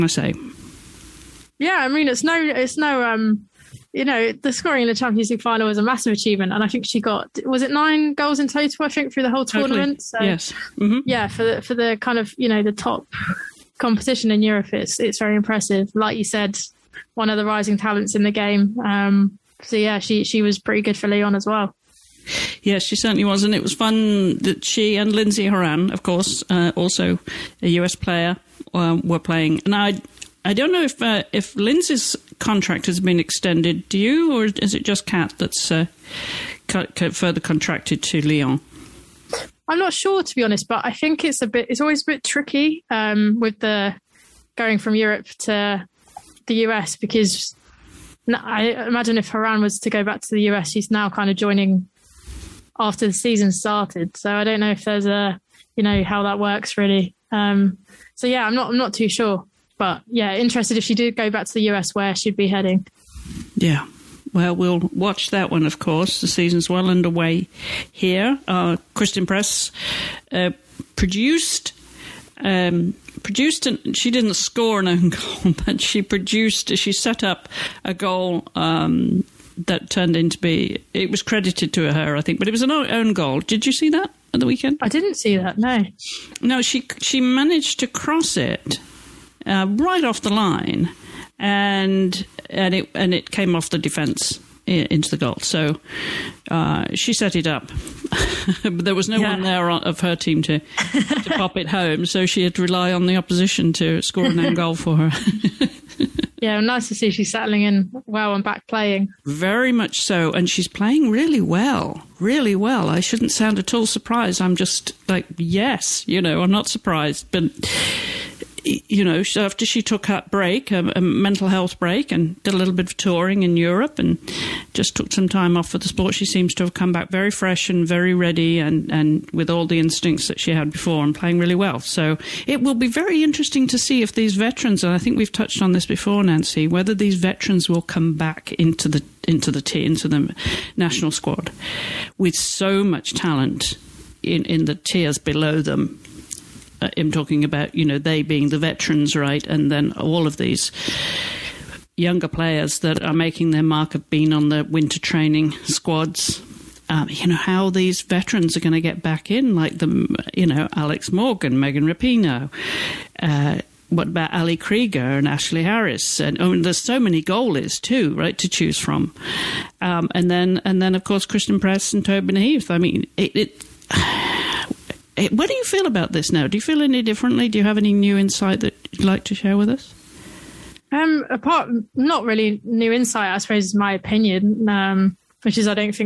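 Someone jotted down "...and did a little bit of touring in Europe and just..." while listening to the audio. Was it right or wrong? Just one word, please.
right.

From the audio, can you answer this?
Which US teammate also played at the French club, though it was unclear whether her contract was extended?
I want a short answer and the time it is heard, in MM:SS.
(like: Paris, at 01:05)
Lindsay Horan, at 00:25.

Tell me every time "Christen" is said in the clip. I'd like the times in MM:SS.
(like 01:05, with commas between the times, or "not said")
01:08, 02:51.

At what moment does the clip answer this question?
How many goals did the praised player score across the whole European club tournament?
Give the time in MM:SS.
00:07.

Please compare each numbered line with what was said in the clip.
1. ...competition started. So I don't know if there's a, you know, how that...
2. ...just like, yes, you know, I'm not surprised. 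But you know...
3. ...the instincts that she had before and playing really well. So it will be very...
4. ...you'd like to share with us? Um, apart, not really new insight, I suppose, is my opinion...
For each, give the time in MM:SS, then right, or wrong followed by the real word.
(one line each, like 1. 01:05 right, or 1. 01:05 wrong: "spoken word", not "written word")
1. 00:53 wrong: "season", not "competition"
2. 01:54 right
3. 02:09 right
4. 02:58 right.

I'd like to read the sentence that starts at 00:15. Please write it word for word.
Like you said, one of the rising talents in the game.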